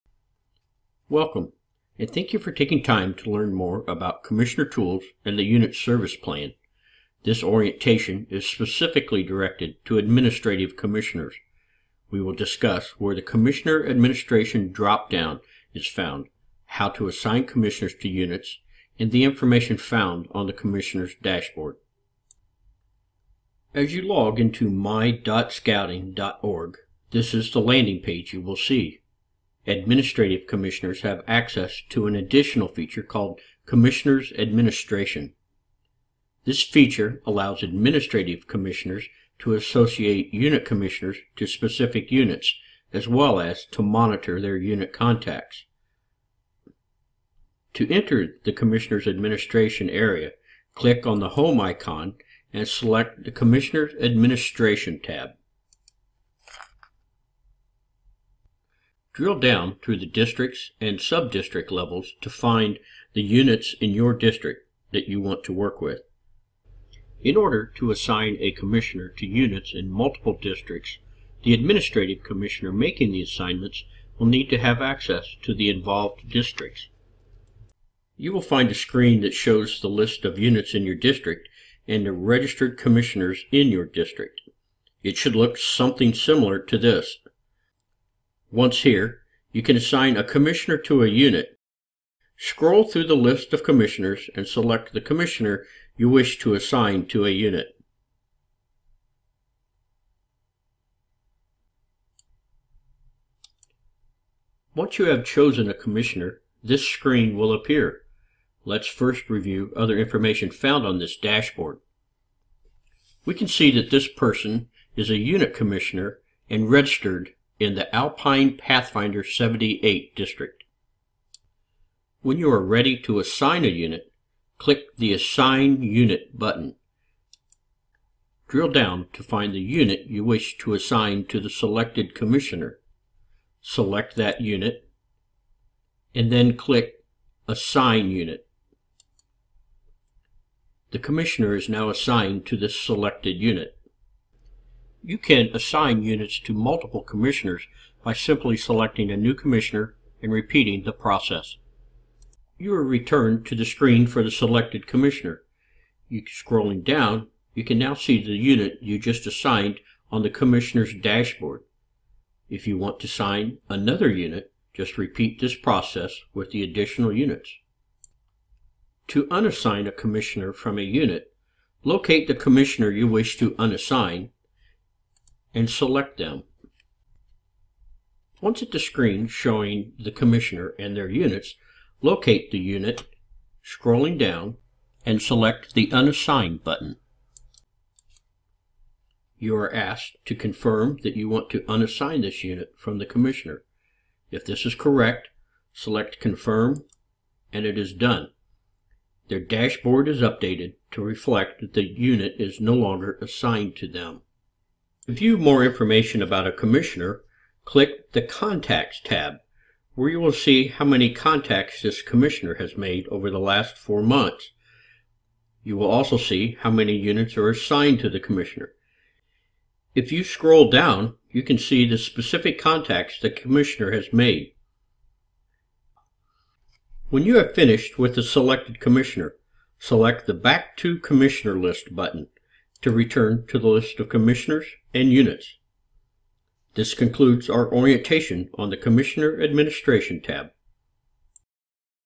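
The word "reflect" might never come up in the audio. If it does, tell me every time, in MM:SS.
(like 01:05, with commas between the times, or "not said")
03:21.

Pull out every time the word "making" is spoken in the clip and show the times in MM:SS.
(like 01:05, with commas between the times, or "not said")
01:12.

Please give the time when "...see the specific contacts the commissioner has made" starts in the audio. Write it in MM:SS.
03:41.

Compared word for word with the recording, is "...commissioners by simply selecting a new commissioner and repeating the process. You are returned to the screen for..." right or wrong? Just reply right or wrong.
right.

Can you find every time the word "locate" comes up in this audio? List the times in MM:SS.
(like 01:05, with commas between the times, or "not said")
02:51, 03:02.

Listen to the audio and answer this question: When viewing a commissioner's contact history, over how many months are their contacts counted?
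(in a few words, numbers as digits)
4.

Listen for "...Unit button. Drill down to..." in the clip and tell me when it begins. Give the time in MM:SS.
02:05.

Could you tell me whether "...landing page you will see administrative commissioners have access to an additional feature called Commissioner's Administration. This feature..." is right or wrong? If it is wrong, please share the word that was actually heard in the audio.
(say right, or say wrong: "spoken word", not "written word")
right.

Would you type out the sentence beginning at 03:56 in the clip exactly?
This concludes our orientation on the Commissioner Administration tab.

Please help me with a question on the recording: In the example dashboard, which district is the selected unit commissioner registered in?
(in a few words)
Alpine Pathfinder 78.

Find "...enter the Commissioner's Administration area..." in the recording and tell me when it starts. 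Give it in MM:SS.
00:47.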